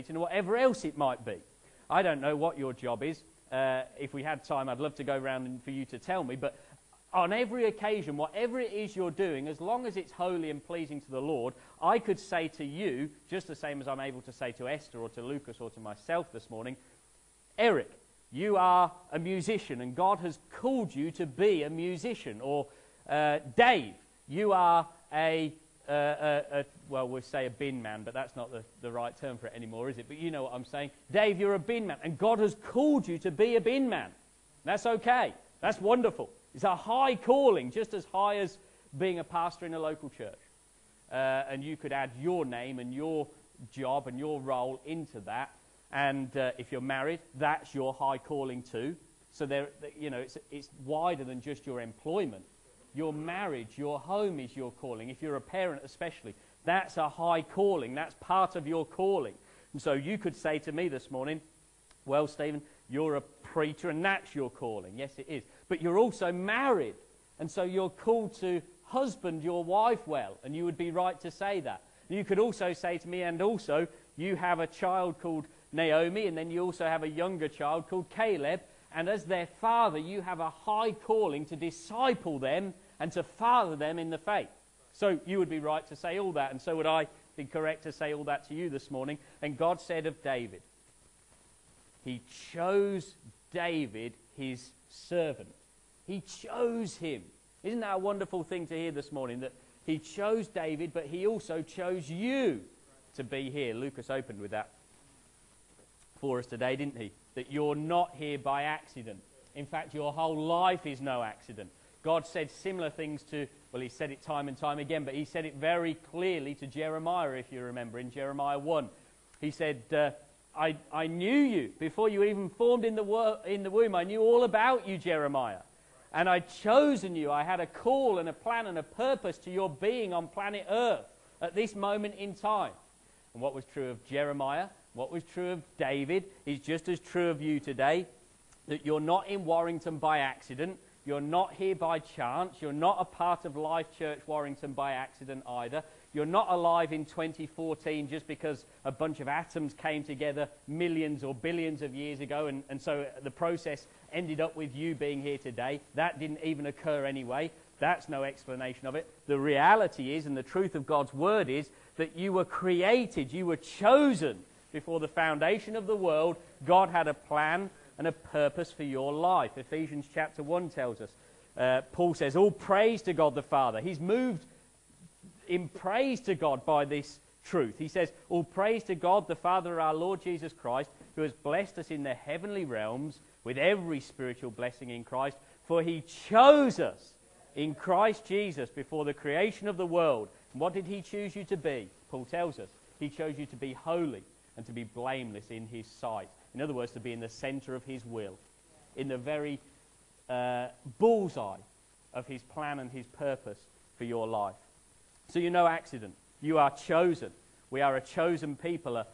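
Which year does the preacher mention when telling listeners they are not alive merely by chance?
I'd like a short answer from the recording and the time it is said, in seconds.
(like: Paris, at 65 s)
2014, at 147 s.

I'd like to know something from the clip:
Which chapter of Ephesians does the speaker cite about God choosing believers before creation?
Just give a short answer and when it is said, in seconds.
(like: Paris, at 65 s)
Chapter 1, at 169 s.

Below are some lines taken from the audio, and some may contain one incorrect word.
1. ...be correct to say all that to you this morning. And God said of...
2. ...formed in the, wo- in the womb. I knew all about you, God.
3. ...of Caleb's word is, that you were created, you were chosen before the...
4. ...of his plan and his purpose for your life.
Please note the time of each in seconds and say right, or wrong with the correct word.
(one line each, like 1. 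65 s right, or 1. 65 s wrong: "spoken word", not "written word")
1. 87 s right
2. 122 s wrong: "Jeremiah", not "God"
3. 160 s wrong: "God", not "Caleb"
4. 202 s right.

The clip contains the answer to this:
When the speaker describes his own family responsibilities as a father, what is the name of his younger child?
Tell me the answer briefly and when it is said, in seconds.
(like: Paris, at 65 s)
Caleb, at 78 s.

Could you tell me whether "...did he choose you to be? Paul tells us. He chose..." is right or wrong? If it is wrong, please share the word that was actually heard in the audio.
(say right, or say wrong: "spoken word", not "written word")
right.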